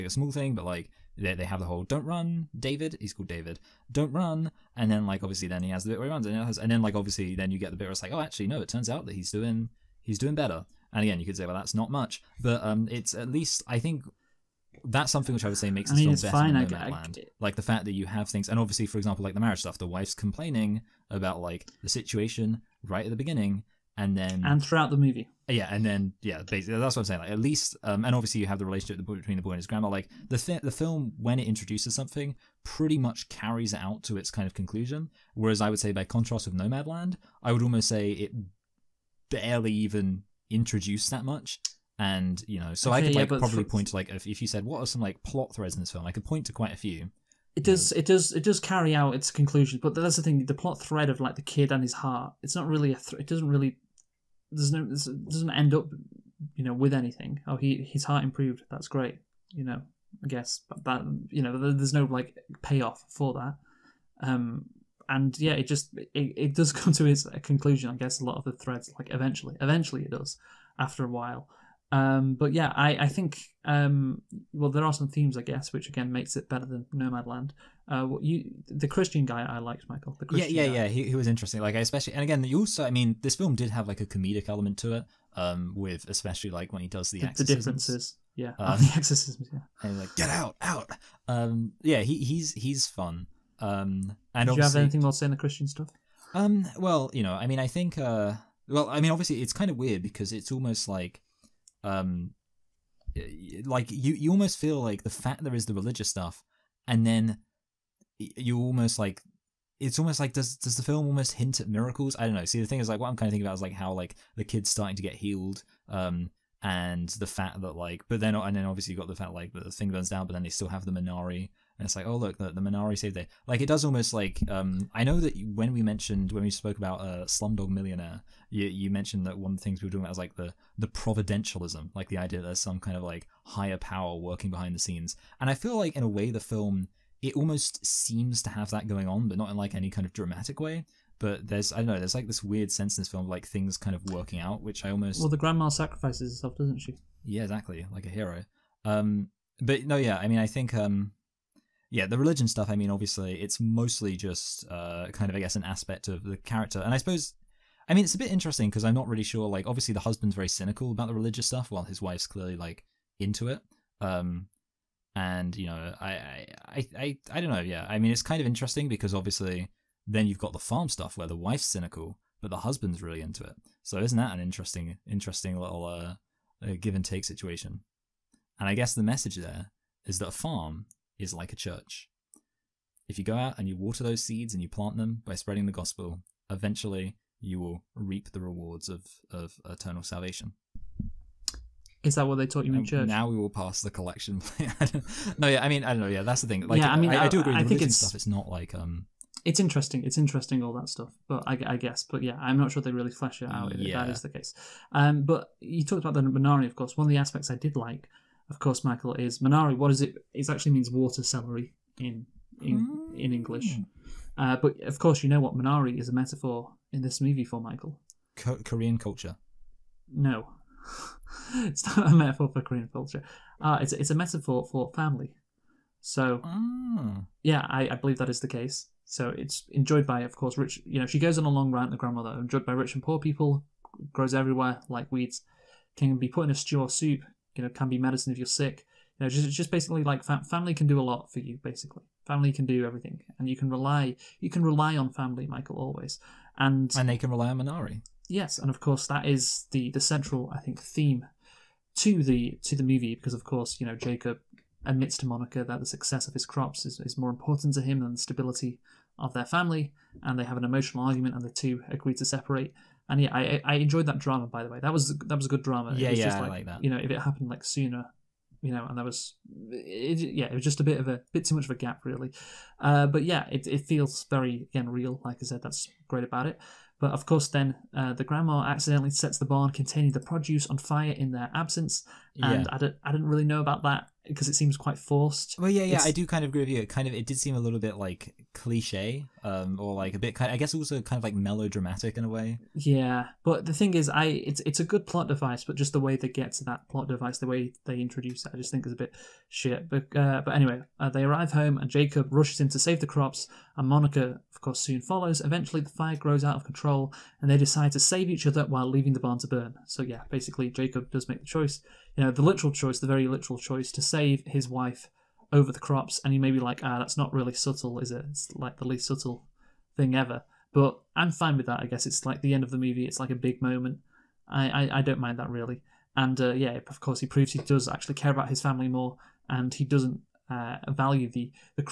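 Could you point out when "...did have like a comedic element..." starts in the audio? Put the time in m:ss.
1:23.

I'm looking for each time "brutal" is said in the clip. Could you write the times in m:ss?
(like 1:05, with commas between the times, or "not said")
not said.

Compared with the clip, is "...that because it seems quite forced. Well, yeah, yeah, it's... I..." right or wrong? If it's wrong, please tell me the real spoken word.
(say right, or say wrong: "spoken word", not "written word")
right.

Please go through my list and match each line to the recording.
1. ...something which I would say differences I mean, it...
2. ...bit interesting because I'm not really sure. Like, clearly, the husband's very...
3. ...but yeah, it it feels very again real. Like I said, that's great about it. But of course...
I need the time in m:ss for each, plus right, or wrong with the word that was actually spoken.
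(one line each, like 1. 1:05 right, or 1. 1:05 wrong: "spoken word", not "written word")
1. 0:15 wrong: "makes", not "differences"
2. 2:38 wrong: "obviously", not "clearly"
3. 4:33 right.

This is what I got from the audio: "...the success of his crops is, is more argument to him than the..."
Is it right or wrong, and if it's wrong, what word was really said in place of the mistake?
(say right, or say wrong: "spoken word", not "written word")
wrong: "important", not "argument".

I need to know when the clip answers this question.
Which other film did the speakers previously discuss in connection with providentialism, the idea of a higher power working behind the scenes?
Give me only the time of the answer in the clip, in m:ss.
2:07.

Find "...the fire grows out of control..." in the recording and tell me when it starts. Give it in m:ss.
5:05.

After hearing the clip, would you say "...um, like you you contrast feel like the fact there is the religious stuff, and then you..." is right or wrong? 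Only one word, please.
wrong.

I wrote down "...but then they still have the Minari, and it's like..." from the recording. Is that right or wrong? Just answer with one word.
right.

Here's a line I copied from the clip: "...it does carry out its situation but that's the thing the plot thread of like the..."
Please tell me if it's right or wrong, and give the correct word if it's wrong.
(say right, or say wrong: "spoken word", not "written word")
wrong: "conclusion", not "situation".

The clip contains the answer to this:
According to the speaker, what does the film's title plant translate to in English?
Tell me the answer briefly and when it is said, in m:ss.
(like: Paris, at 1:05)
Water celery, at 3:30.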